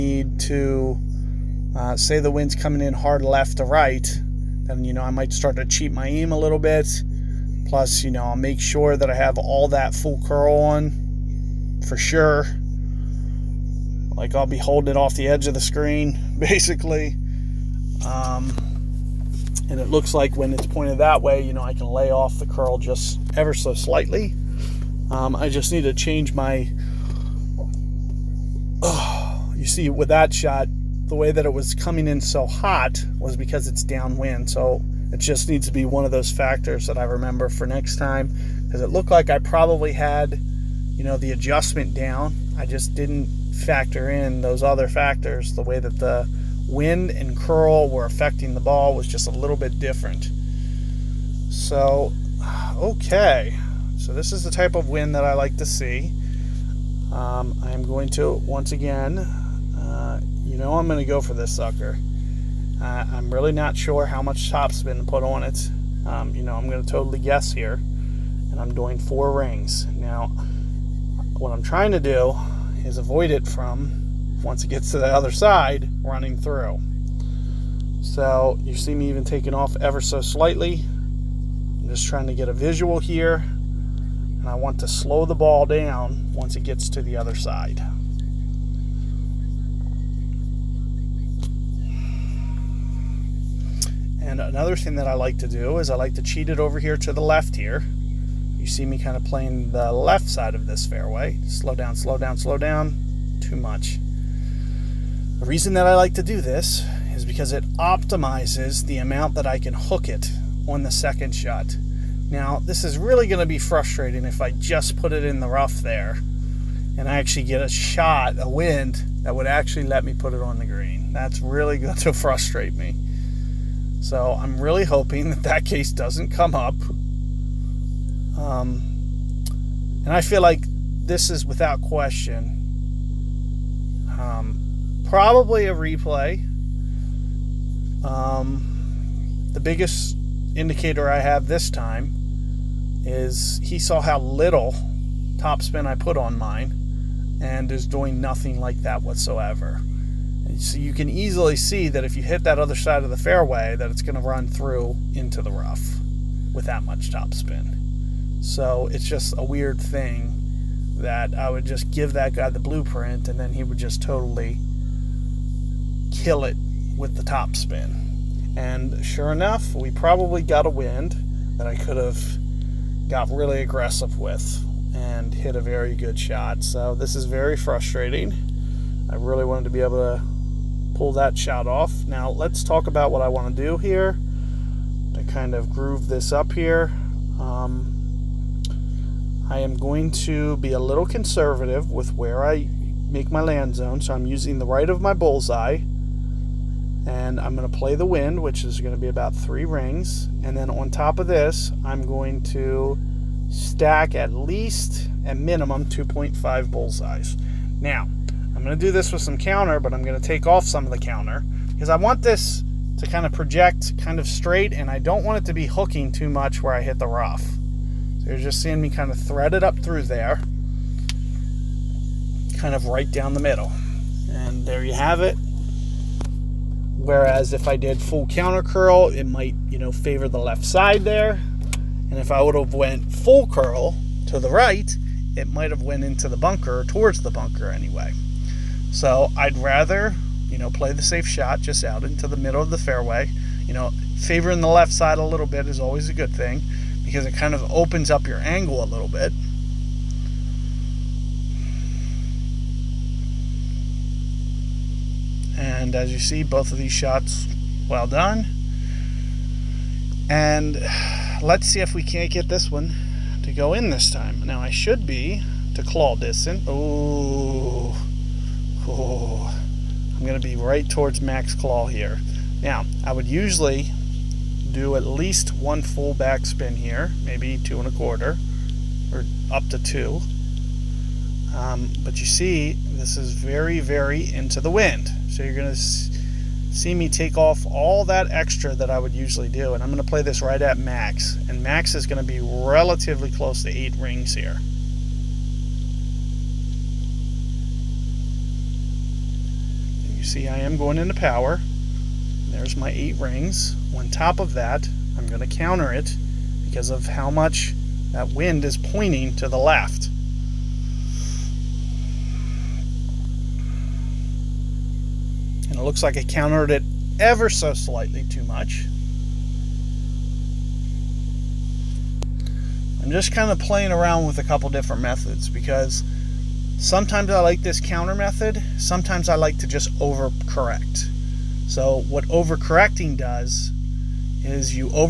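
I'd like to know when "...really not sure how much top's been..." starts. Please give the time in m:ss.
1:03.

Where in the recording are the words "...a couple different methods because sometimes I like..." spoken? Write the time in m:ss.
5:24.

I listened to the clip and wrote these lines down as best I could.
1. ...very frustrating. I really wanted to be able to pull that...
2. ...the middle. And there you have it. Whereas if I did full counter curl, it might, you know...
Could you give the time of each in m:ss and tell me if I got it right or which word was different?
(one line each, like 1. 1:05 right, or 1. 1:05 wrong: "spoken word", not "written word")
1. 2:57 right
2. 3:43 right.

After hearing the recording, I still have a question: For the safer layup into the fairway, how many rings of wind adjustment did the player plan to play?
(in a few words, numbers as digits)
3 rings.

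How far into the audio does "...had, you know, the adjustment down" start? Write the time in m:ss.
0:39.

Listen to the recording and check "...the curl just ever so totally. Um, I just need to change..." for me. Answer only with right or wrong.
wrong.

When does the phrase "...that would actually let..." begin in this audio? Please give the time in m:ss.
1:59.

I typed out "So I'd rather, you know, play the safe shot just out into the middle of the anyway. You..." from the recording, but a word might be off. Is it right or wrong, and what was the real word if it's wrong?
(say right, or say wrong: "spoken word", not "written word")
wrong: "fairway", not "anyway".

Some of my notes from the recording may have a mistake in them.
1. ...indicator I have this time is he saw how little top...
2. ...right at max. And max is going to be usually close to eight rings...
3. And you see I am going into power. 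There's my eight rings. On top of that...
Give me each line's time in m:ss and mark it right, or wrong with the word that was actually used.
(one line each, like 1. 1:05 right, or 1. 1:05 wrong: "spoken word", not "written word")
1. 2:20 right
2. 4:50 wrong: "relatively", not "usually"
3. 5:00 right.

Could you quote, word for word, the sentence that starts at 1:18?
So you see me even taking off ever so slightly.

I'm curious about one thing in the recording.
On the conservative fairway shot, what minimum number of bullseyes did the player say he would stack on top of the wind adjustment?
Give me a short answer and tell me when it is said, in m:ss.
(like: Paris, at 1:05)
2.5, at 3:25.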